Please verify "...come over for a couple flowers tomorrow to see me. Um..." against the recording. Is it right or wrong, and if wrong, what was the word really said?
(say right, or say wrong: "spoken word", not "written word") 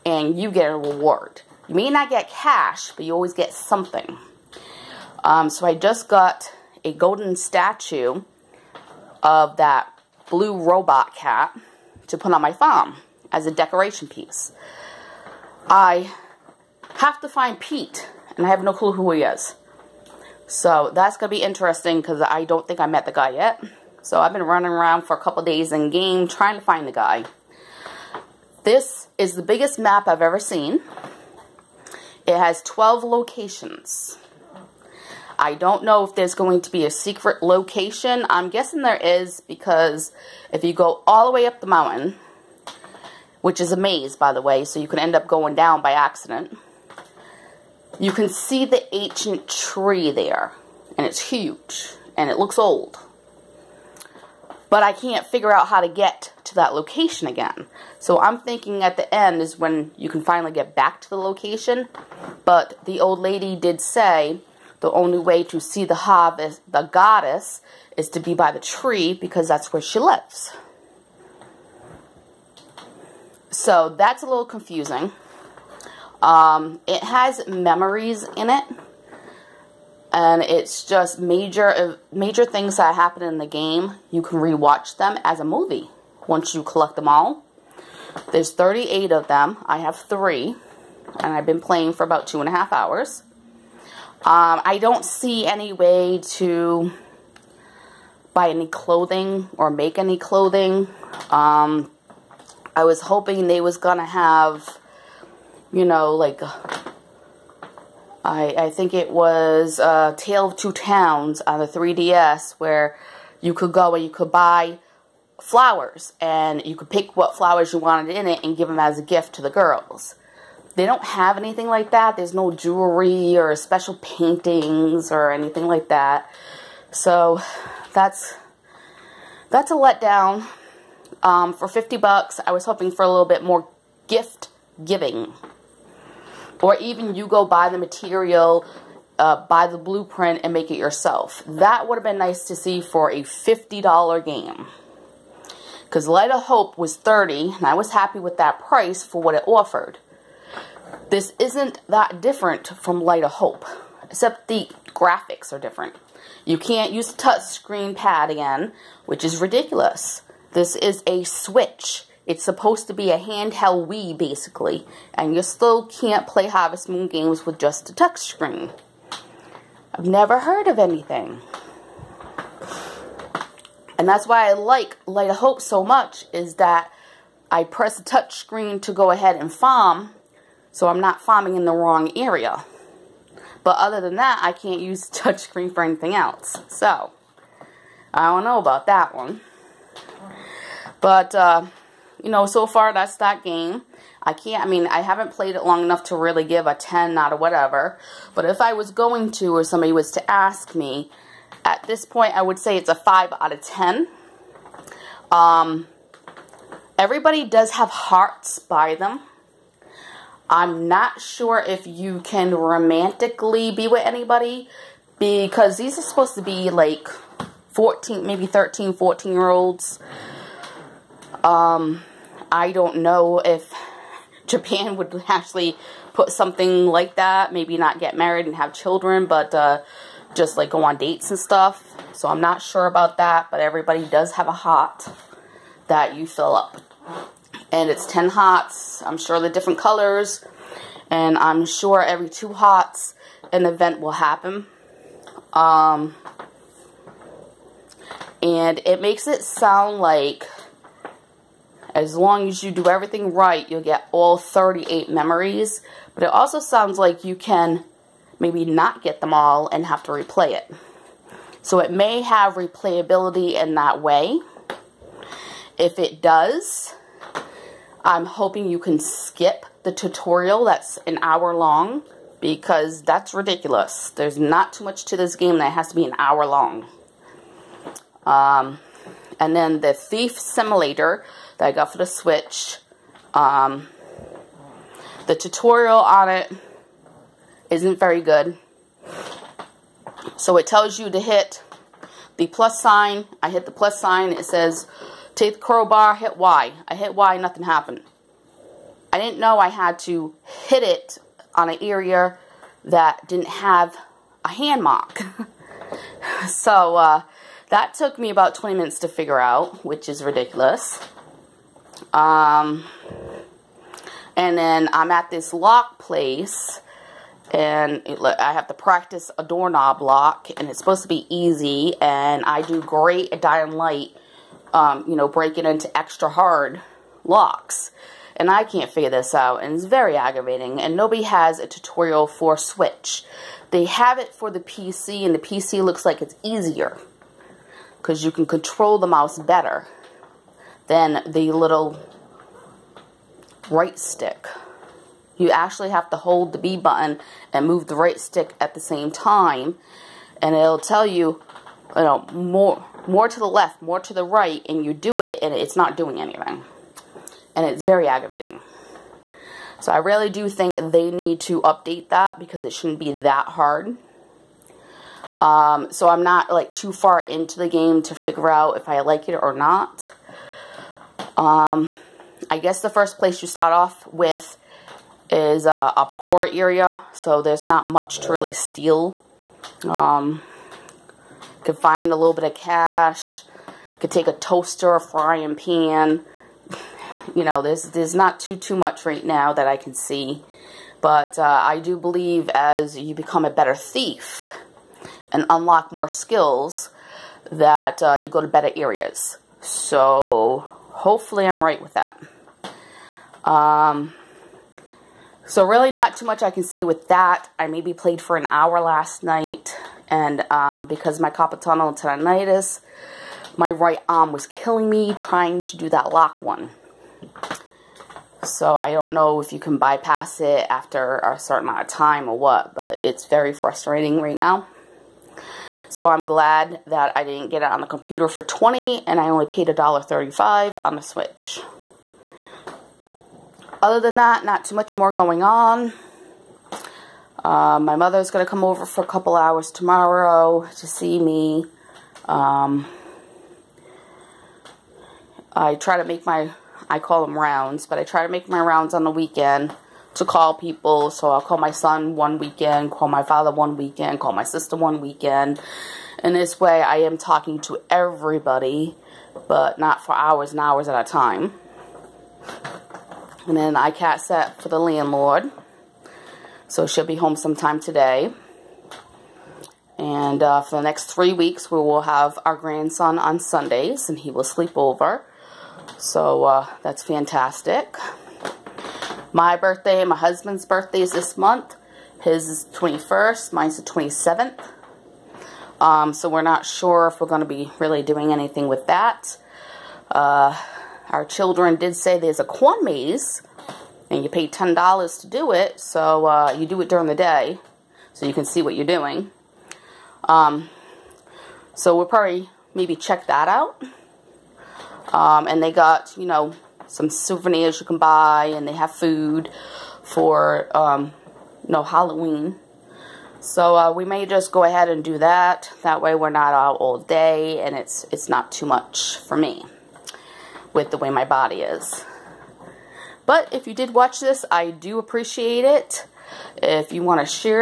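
wrong: "hours", not "flowers".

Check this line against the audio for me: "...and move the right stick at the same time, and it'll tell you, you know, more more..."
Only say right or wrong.
right.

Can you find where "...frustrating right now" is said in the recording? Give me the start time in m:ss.
7:03.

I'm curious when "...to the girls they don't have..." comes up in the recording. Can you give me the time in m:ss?
1:59.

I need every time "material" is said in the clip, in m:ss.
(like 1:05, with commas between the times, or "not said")
2:17.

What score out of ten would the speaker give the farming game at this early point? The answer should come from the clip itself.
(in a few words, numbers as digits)
5 out of 10.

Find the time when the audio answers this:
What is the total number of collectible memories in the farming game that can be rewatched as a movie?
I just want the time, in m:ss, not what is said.
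1:28.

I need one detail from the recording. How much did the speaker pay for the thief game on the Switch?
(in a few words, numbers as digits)
$1.35.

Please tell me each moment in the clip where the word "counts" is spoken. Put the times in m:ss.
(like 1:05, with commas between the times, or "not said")
not said.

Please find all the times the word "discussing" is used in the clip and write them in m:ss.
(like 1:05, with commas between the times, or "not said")
not said.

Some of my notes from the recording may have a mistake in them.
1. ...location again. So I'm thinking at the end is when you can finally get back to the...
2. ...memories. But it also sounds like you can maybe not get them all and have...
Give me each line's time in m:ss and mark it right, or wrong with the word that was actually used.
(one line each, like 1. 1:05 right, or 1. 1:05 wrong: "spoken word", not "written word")
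1. 0:56 right
2. 4:15 right.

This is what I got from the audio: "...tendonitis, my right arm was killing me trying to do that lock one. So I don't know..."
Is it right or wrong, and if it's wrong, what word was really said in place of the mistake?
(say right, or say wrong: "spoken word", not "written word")
right.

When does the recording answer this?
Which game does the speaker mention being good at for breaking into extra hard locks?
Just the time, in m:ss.
5:23.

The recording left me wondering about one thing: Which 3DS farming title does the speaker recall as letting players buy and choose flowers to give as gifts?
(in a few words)
Tale of Two Towns.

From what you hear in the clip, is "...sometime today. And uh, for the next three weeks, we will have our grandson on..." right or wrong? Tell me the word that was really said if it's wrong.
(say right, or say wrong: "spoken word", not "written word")
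right.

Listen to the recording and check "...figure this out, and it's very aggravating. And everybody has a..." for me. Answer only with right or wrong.
wrong.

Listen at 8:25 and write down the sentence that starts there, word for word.
Um, and they got, you know, some souvenirs you can buy and they have food for, um, you know, Halloween.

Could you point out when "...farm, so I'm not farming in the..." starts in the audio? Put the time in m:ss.
2:59.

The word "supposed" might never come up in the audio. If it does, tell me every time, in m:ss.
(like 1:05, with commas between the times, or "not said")
2:42, 3:36, 5:20.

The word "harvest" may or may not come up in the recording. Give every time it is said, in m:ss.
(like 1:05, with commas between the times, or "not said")
1:05, 2:46.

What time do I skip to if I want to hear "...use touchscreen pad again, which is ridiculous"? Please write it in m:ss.
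2:36.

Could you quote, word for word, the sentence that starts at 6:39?
So hopefully I'm right with that.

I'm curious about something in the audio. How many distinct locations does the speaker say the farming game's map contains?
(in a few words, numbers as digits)
12.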